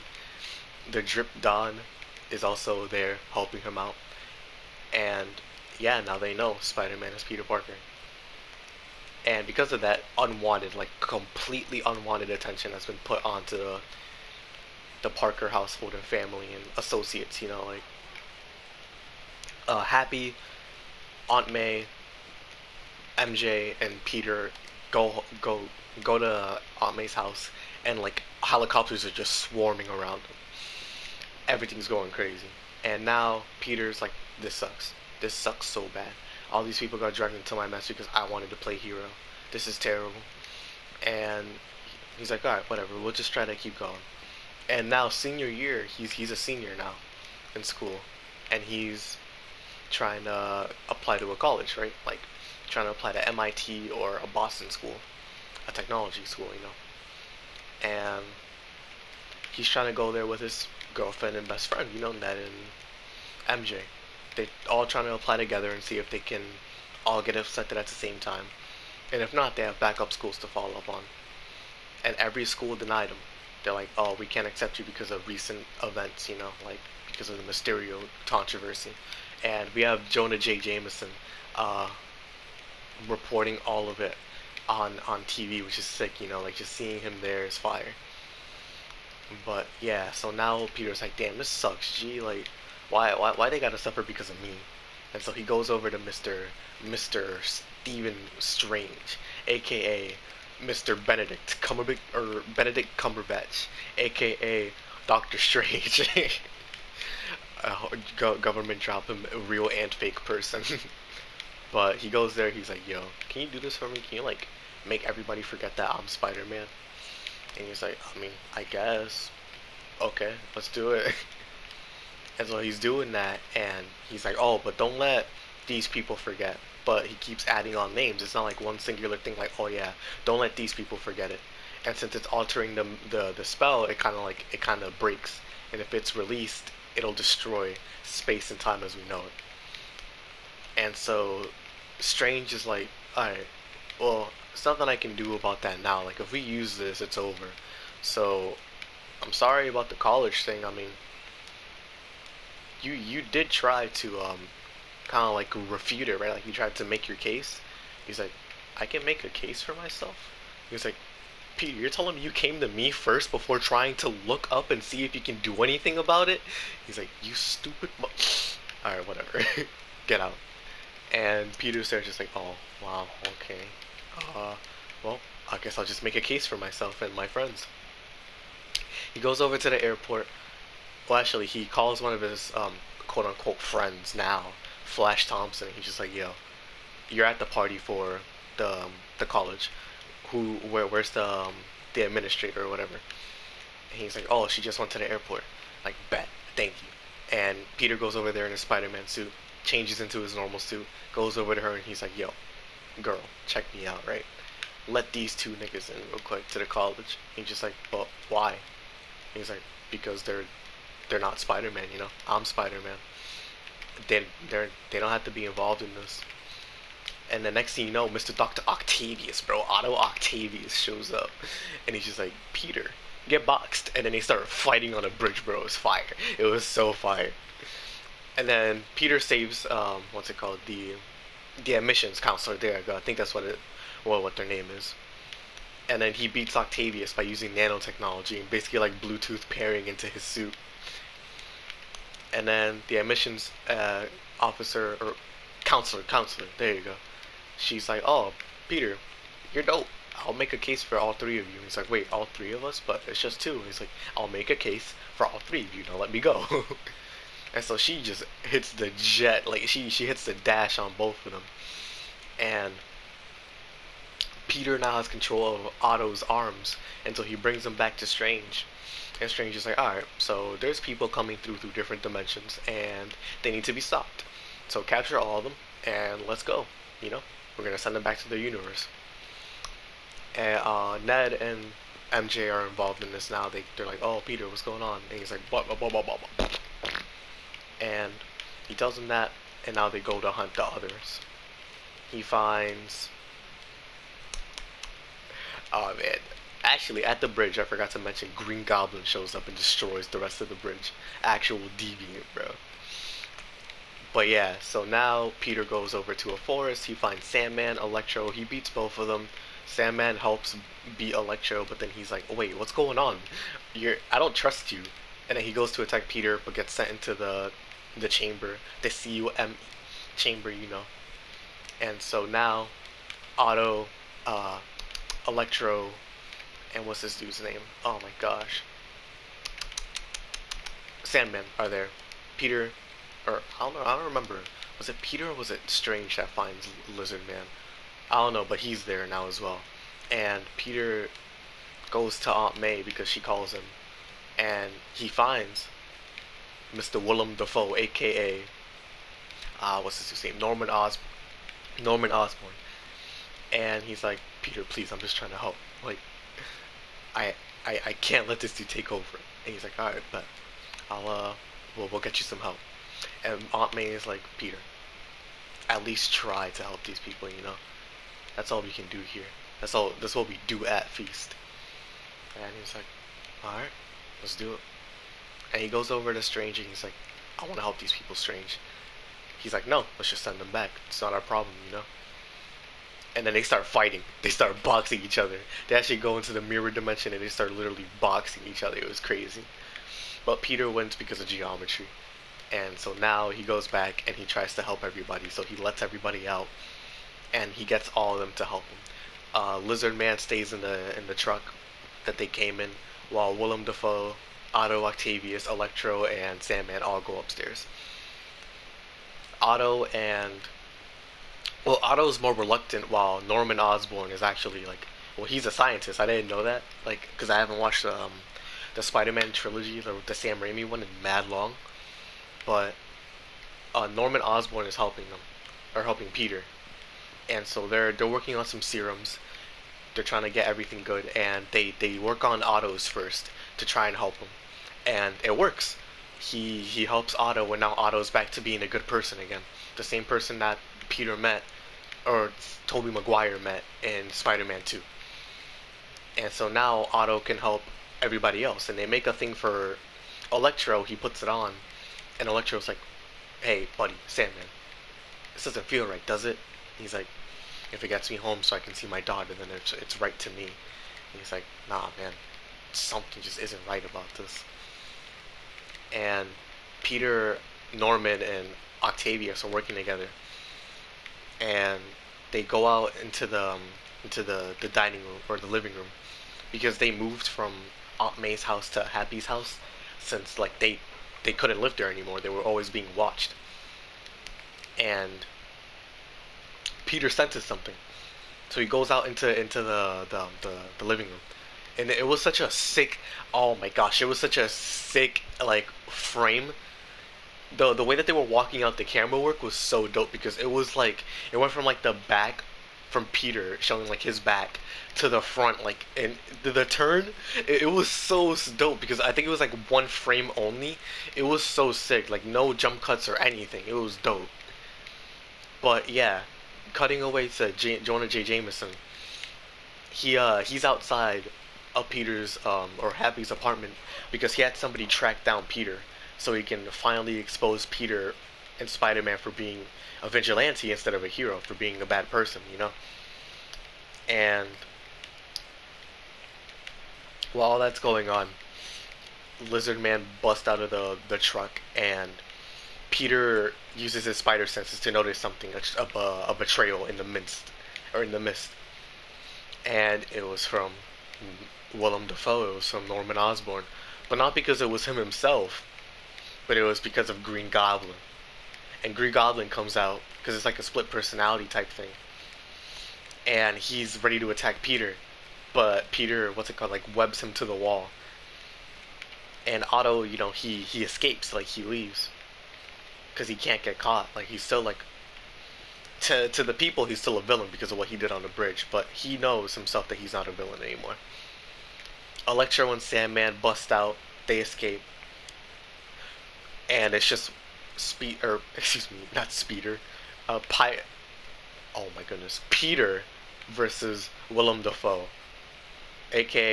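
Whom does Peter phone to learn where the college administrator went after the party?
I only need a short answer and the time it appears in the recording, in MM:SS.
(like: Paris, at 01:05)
Flash Thompson, at 03:04.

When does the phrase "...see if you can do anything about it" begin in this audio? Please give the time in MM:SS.
02:44.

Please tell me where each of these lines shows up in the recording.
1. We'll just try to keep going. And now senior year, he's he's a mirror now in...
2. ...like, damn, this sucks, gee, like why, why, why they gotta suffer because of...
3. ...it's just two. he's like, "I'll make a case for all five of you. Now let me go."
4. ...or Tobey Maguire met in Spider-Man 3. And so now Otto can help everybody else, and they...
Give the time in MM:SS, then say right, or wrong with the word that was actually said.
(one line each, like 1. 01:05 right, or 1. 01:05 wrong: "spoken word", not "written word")
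1. 00:42 wrong: "senior", not "mirror"
2. 01:31 right
3. 04:13 wrong: "three", not "five"
4. 07:22 wrong: "2", not "3".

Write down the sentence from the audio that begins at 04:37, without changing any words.
You know, we're going to send them back to their universe.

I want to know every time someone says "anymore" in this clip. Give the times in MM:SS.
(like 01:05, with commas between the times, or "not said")
08:01, 09:40.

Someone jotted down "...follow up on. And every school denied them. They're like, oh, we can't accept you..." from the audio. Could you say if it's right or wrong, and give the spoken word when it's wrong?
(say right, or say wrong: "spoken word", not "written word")
right.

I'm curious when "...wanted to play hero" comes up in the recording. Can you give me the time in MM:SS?
00:38.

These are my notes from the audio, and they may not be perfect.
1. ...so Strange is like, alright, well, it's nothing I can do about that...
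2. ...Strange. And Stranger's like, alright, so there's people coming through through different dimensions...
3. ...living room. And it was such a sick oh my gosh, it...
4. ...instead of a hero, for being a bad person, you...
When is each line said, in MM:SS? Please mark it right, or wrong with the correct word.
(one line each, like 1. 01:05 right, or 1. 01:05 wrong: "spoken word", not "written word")
1. 02:20 right
2. 04:28 right
3. 08:10 right
4. 08:50 right.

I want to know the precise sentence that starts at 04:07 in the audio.
She's like, "Oh, Peter, you're dope.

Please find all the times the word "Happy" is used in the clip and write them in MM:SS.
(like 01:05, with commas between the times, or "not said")
00:19, 07:58, 08:42.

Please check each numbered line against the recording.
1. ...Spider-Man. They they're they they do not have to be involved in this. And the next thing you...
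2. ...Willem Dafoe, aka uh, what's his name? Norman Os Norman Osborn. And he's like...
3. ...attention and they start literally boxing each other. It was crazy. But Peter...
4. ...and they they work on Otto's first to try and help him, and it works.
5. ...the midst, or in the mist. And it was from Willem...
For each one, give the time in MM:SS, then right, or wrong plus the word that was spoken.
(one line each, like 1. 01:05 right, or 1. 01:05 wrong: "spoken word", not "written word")
1. 03:32 right
2. 05:47 right
3. 06:26 wrong: "dimension", not "attention"
4. 07:11 right
5. 09:06 right.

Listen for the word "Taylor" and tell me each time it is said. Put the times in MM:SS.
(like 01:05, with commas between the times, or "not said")
not said.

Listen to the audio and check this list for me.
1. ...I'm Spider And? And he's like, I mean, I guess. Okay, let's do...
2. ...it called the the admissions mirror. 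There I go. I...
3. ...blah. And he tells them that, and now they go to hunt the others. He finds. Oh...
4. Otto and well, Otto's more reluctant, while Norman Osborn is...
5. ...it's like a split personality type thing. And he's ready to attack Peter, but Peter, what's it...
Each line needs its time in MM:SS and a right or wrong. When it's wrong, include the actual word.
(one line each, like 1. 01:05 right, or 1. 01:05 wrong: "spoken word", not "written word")
1. 01:55 wrong: "Man", not "And"
2. 03:50 wrong: "counselor", not "mirror"
3. 04:46 right
4. 06:49 right
5. 09:20 right.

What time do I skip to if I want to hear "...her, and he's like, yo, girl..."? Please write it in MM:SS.
03:21.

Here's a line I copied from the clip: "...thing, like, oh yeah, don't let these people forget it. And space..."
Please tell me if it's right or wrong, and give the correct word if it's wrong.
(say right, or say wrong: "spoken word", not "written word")
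wrong: "since", not "space".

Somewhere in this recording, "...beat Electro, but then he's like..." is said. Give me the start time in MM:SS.
05:10.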